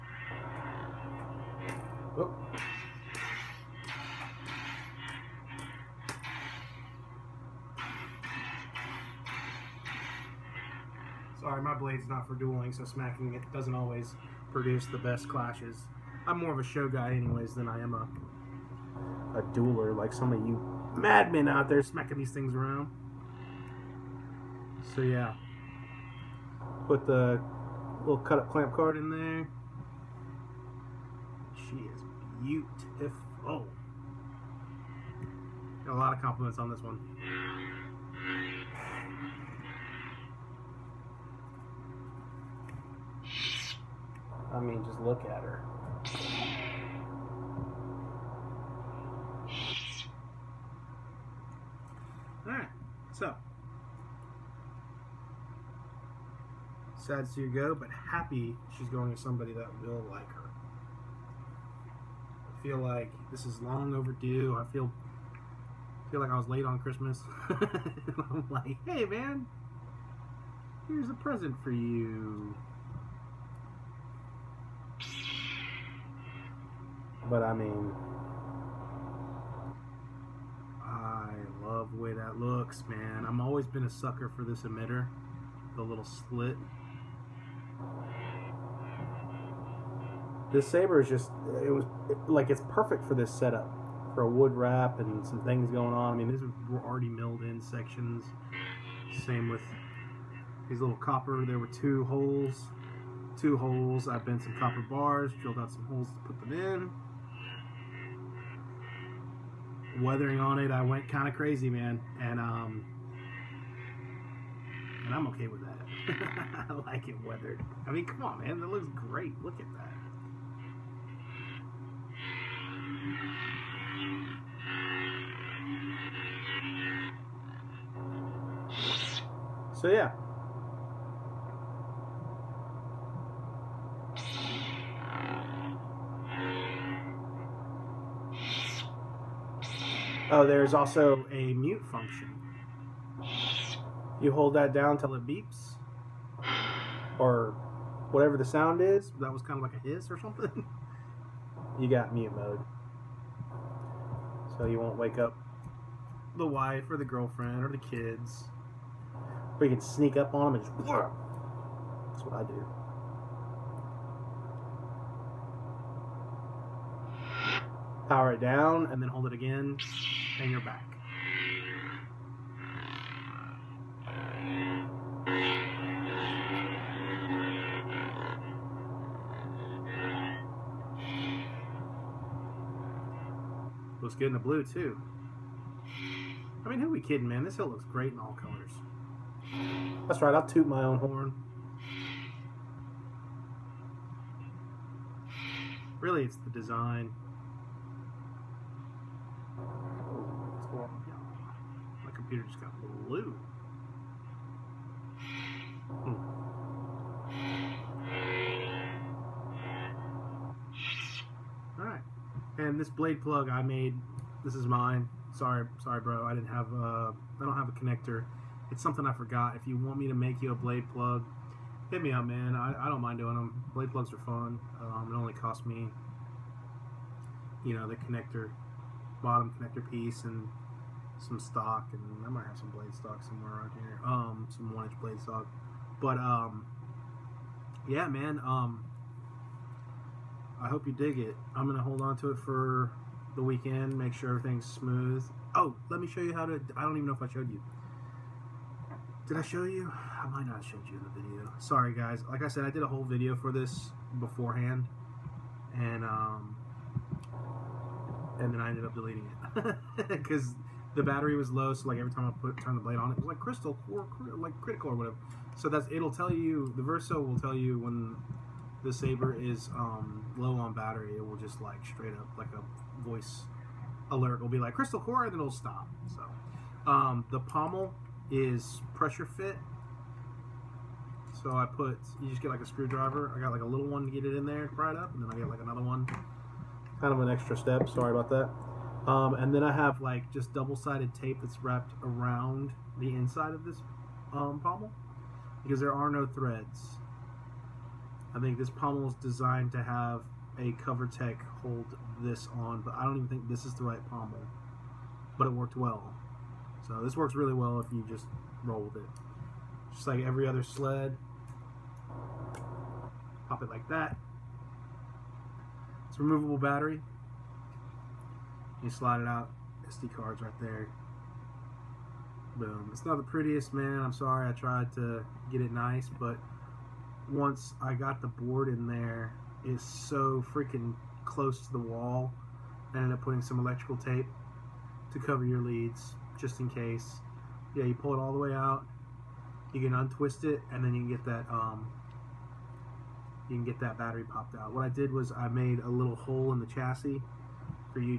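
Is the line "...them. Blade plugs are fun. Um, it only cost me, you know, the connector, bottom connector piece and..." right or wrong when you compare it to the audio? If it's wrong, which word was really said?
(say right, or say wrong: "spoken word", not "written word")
right.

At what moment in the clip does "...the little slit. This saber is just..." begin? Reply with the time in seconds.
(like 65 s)
85 s.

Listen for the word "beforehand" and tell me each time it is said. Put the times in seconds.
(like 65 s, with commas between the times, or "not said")
254 s.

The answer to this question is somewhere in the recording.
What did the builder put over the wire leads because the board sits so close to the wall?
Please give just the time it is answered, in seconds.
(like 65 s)
333 s.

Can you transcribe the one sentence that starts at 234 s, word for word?
Um, some one inch blade stock, but um, yeah, man.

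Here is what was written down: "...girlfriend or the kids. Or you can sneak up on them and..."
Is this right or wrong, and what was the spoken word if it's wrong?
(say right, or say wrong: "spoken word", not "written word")
right.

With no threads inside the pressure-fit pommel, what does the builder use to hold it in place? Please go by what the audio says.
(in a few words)
Double sided tape.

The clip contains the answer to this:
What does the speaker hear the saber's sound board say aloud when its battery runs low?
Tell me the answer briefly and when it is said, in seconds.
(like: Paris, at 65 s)
Crystal core, at 274 s.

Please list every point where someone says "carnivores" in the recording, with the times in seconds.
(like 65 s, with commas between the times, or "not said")
not said.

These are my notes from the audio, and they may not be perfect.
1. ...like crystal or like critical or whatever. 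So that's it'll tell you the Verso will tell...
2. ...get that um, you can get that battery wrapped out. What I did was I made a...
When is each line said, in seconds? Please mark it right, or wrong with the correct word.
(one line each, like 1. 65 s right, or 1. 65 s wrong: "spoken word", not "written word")
1. 263 s right
2. 341 s wrong: "popped", not "wrapped".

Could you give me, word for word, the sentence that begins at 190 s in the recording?
That's right, I'll toot my own horn.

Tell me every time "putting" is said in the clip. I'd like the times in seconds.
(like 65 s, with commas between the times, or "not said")
333 s.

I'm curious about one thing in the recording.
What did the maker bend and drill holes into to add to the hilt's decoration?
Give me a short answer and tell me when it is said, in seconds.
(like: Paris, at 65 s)
Copper bars, at 104 s.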